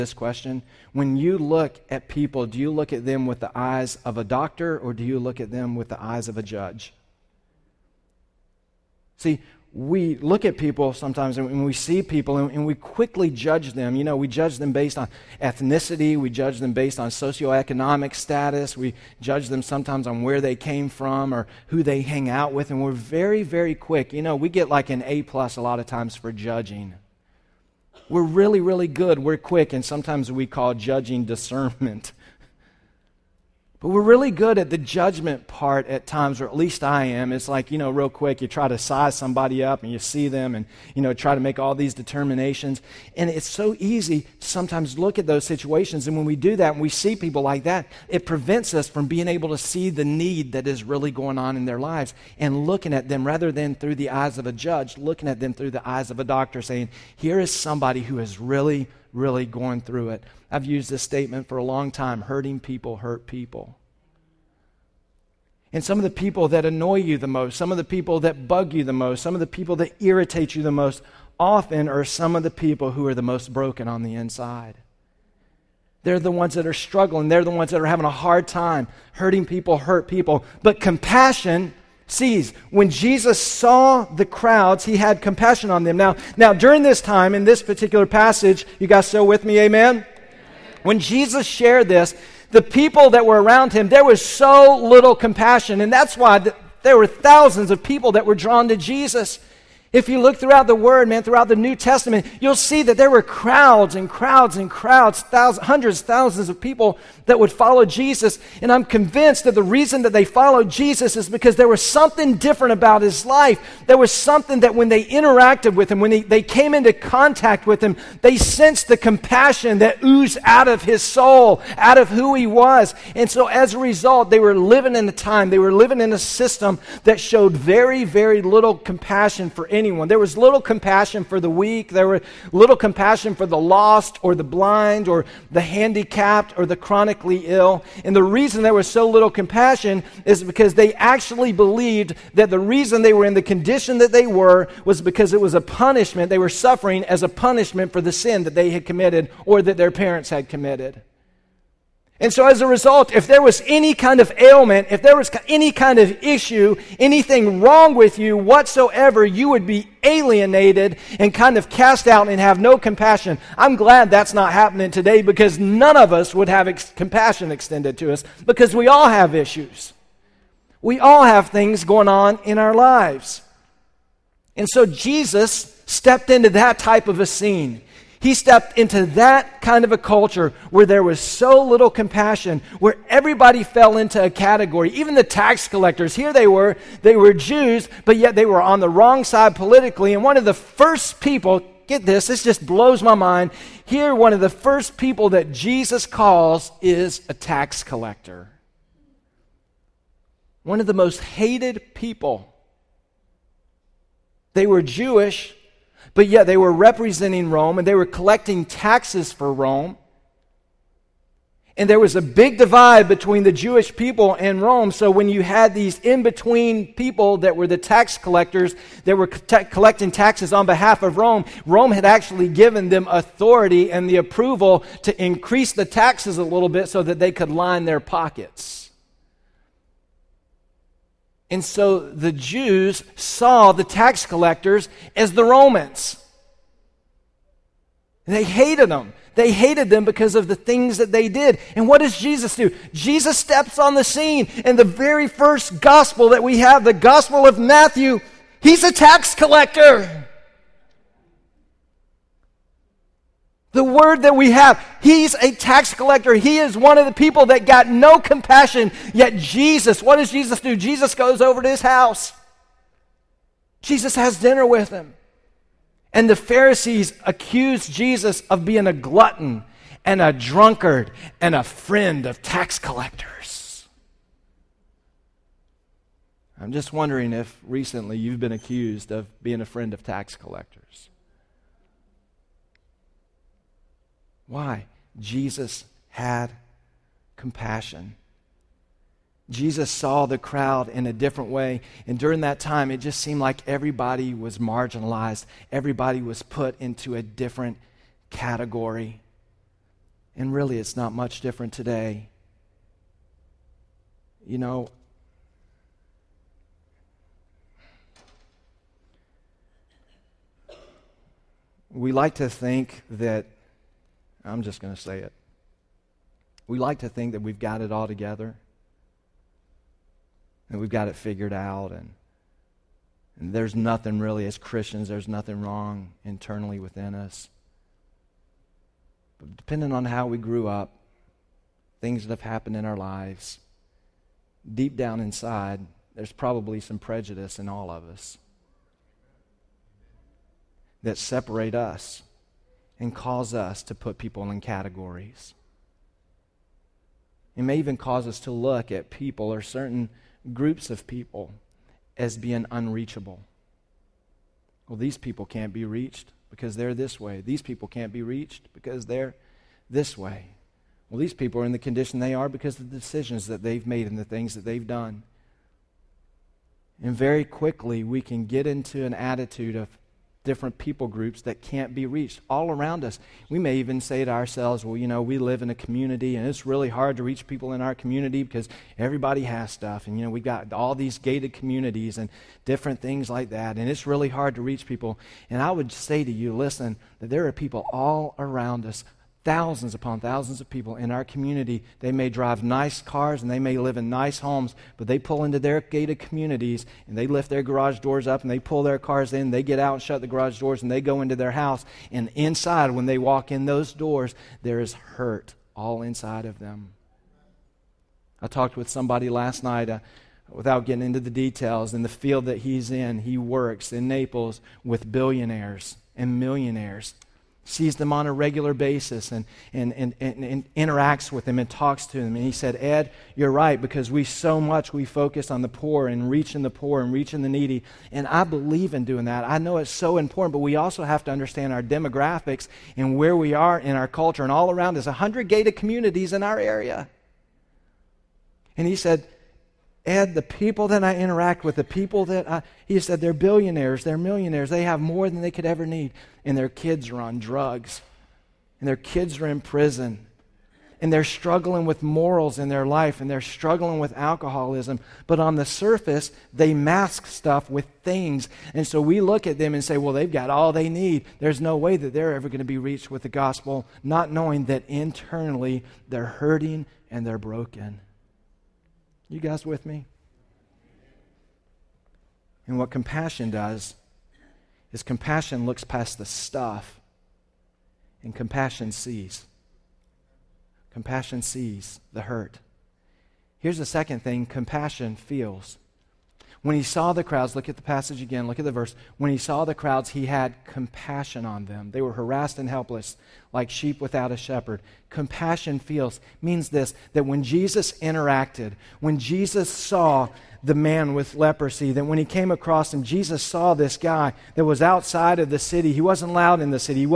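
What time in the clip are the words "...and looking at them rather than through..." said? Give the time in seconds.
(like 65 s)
52 s.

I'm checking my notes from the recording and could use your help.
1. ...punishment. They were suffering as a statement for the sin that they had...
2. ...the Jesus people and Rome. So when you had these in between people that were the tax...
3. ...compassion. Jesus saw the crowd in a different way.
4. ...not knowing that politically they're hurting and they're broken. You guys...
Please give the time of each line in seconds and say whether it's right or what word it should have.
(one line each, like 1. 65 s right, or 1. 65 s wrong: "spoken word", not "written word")
1. 145 s wrong: "punishment", not "statement"
2. 213 s wrong: "Jewish", not "Jesus"
3. 287 s right
4. 464 s wrong: "internally", not "politically".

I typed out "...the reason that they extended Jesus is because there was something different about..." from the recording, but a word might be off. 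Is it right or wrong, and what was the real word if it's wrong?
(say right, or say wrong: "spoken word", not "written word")
wrong: "followed", not "extended".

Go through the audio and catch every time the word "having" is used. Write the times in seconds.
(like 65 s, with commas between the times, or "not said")
77 s.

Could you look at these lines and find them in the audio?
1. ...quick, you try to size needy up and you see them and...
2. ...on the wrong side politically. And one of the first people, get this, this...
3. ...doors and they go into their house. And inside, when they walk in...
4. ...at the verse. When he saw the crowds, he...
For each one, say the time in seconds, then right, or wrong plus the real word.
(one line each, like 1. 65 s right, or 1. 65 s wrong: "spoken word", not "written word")
1. 38 s wrong: "somebody", not "needy"
2. 188 s right
3. 400 s right
4. 488 s right.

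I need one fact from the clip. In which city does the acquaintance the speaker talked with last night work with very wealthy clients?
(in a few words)
Naples.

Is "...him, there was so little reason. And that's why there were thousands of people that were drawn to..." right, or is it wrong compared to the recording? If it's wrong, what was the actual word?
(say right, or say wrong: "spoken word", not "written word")
wrong: "compassion", not "reason".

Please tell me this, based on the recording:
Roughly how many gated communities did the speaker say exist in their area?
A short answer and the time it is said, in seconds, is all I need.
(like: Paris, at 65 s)
100, at 435 s.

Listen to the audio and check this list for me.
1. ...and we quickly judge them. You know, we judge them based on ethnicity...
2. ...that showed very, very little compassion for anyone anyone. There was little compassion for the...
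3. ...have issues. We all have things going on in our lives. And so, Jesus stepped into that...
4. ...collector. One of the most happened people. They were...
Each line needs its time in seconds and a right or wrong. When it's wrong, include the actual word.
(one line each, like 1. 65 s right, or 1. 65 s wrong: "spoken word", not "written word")
1. 12 s right
2. 127 s right
3. 169 s right
4. 197 s wrong: "hated", not "happened".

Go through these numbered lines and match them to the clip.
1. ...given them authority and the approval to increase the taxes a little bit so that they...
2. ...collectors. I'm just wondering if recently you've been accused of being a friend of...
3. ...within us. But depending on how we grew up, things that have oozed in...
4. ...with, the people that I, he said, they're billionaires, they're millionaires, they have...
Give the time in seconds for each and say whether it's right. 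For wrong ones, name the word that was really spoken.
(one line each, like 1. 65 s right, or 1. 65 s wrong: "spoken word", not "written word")
1. 222 s right
2. 272 s right
3. 326 s wrong: "happened", not "oozed"
4. 441 s right.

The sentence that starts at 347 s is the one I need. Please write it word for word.
It may even cause us to look at people or certain groups of people as being unreachable.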